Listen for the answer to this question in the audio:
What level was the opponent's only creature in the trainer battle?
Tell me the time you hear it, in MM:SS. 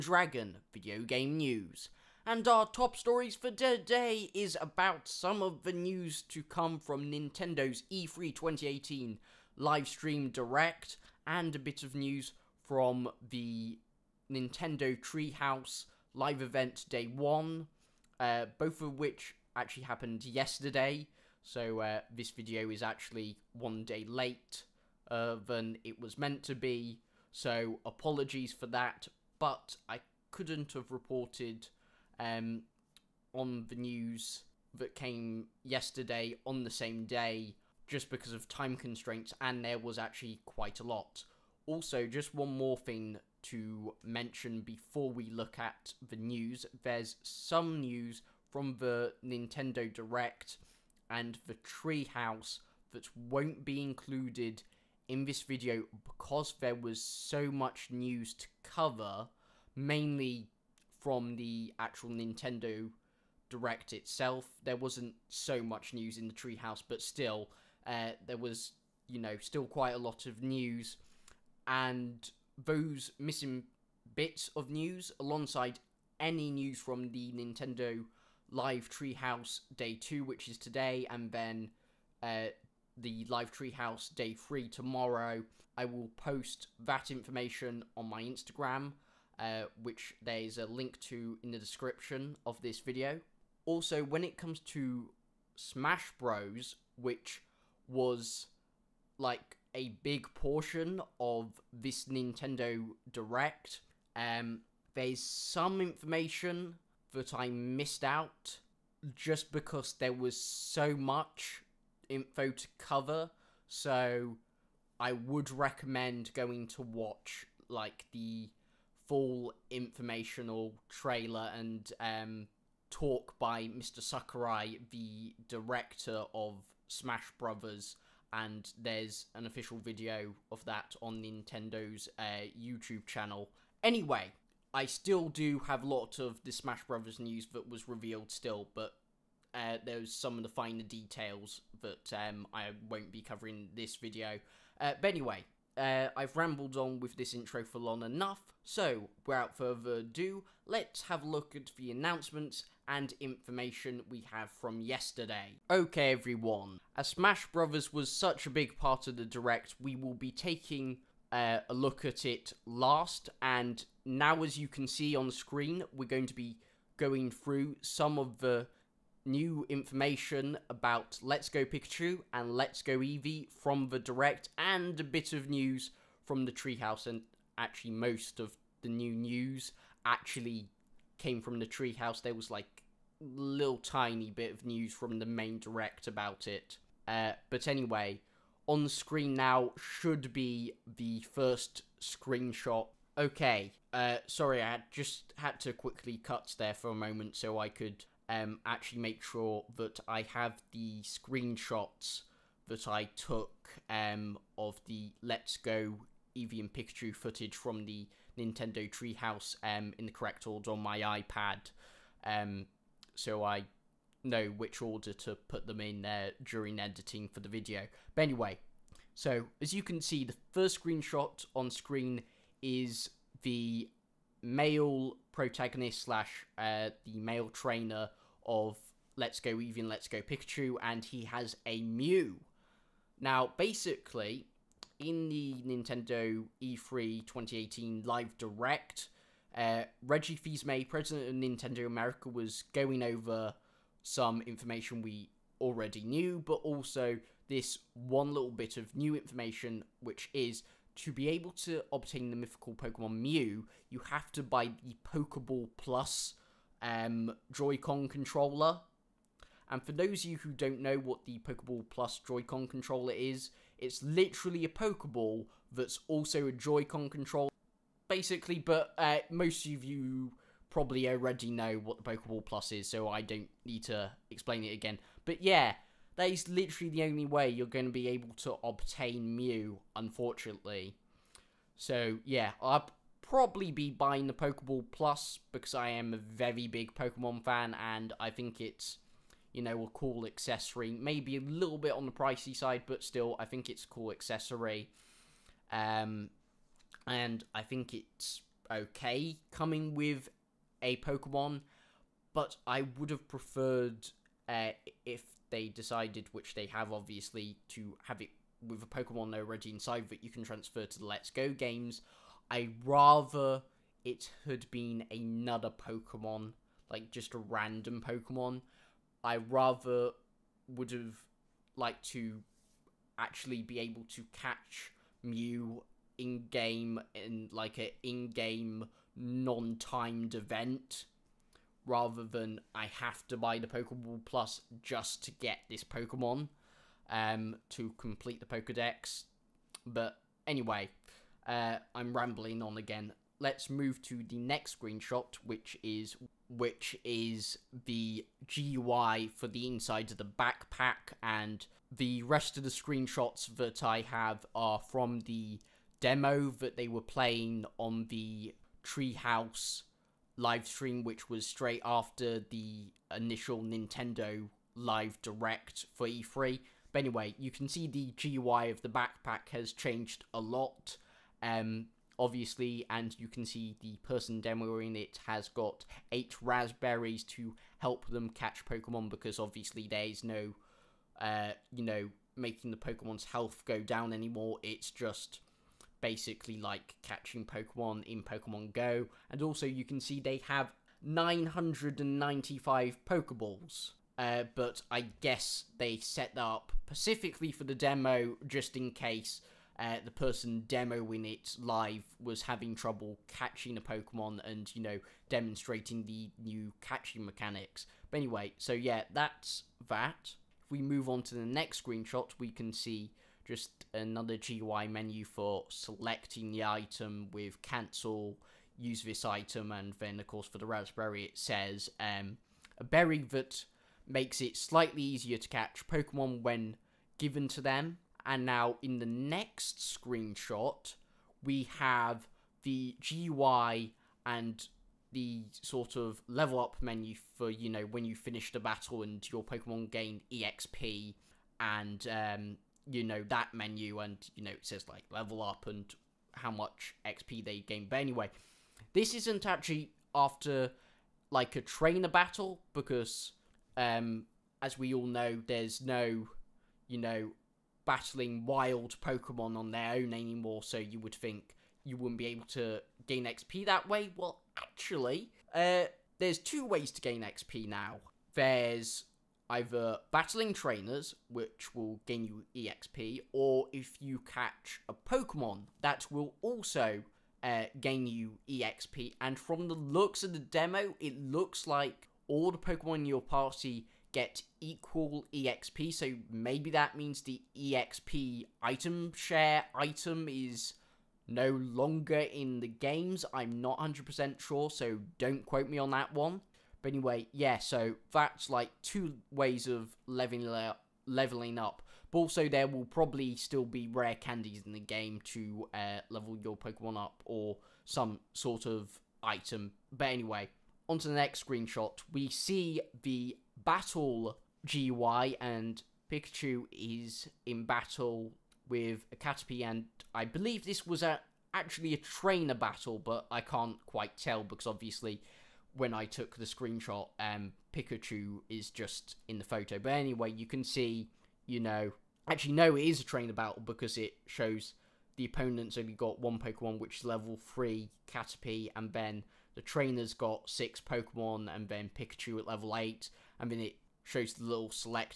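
08:57.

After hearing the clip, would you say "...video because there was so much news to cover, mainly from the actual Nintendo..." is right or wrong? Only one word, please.
right.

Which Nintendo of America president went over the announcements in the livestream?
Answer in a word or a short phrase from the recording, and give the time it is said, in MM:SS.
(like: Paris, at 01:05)
Reggie Fils-Aimé, at 04:00.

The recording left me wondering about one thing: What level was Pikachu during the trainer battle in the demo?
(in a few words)
8.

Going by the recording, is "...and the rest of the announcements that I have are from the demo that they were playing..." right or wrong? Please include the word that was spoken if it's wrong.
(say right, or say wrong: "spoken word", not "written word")
wrong: "screenshots", not "announcements".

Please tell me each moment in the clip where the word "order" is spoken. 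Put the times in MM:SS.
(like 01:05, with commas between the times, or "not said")
03:30, 03:34.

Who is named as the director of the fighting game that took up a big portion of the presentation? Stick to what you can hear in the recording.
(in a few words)
Mr. Sakurai.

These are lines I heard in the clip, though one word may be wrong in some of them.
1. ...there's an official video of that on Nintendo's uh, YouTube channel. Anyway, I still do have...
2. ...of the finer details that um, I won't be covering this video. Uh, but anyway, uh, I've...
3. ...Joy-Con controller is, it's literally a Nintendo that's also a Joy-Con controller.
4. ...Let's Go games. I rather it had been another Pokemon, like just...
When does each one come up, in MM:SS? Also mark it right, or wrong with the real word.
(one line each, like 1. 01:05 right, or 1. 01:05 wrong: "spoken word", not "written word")
1. 02:08 right
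2. 02:20 right
3. 04:22 wrong: "Pokeball", not "Nintendo"
4. 05:11 right.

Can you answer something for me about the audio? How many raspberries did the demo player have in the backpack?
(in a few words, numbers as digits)
8.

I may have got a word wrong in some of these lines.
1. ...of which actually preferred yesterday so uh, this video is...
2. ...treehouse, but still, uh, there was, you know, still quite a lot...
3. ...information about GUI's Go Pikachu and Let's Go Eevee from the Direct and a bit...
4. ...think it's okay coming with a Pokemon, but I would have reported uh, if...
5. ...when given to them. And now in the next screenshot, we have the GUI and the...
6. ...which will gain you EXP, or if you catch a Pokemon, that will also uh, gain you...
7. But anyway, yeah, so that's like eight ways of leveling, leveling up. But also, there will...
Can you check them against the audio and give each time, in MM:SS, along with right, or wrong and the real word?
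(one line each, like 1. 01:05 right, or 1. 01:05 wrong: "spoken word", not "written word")
1. 00:18 wrong: "happened", not "preferred"
2. 01:06 right
3. 02:49 wrong: "Let", not "GUI"
4. 04:57 wrong: "preferred", not "reported"
5. 07:06 right
6. 07:51 right
7. 08:16 wrong: "two", not "eight".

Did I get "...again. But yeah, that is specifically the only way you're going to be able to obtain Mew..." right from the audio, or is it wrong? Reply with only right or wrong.
wrong.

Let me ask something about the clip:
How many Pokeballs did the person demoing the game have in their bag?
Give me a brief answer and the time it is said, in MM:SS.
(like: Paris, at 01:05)
995, at 06:31.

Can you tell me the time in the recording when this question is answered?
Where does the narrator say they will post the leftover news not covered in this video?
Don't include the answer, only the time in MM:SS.
01:28.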